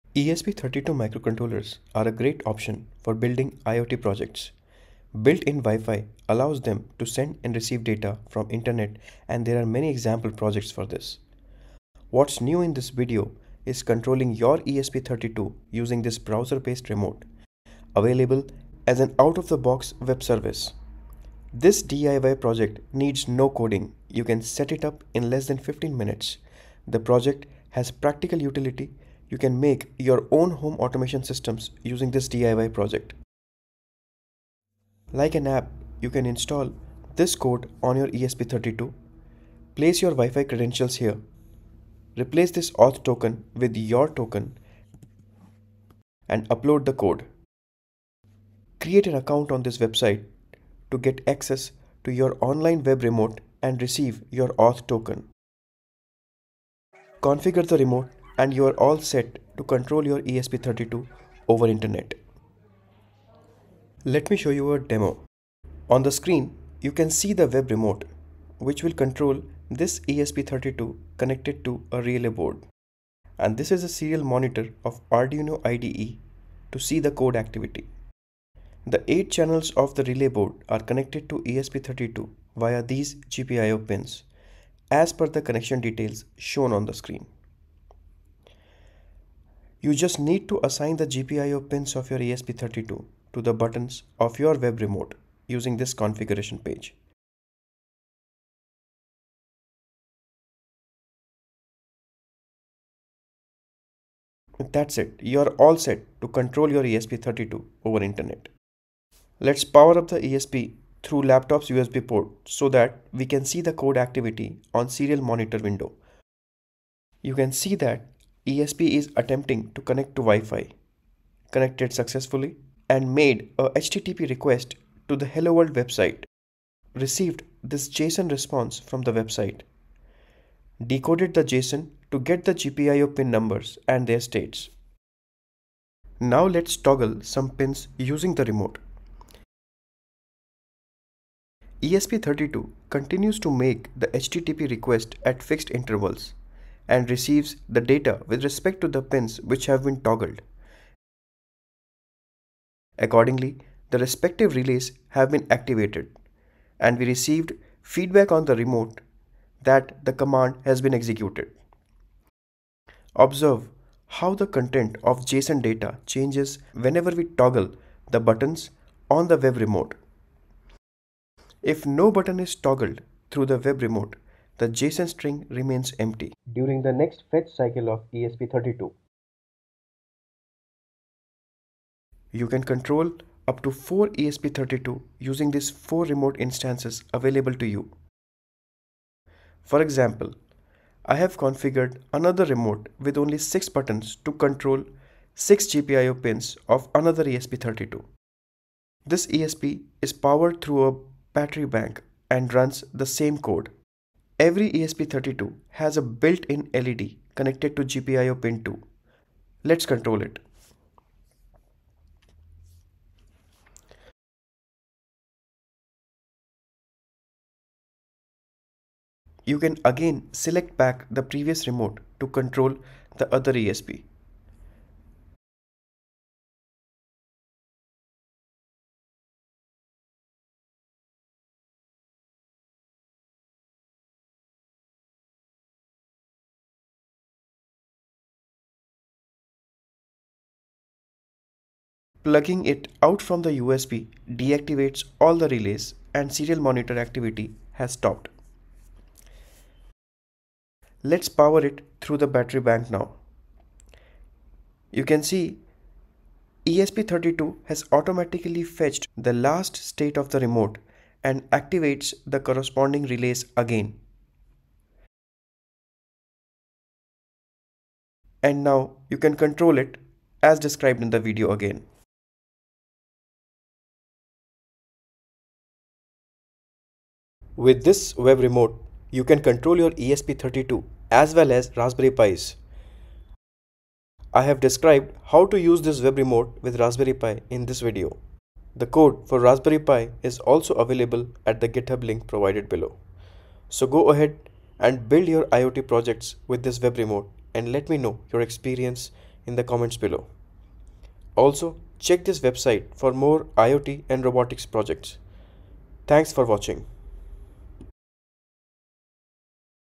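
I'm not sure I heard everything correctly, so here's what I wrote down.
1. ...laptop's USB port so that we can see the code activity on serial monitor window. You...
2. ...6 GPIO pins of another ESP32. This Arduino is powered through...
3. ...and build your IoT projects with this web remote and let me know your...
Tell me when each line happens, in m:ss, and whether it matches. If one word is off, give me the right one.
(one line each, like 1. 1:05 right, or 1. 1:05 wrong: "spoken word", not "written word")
1. 1:51 right
2. 3:15 wrong: "ESP", not "Arduino"
3. 4:54 right.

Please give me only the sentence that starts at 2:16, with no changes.
Now let's toggle some pins using the remote.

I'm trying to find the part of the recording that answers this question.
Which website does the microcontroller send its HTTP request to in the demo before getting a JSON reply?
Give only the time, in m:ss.
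2:05.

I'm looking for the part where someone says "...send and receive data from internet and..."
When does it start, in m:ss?
0:07.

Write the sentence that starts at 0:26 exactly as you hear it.
The project has practical utility you can make your own home automation systems using this DIY project.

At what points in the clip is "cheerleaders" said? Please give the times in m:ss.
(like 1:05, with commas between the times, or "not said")
not said.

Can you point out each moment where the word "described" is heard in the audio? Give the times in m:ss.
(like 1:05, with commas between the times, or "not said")
4:30, 4:44.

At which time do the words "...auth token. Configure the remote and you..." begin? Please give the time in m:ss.
0:54.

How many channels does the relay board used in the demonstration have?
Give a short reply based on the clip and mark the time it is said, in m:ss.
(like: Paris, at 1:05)
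8, at 1:19.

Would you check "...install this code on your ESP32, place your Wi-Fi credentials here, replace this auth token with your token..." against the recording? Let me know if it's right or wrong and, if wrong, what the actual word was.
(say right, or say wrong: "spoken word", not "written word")
right.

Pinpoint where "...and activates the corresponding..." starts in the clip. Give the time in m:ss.
4:21.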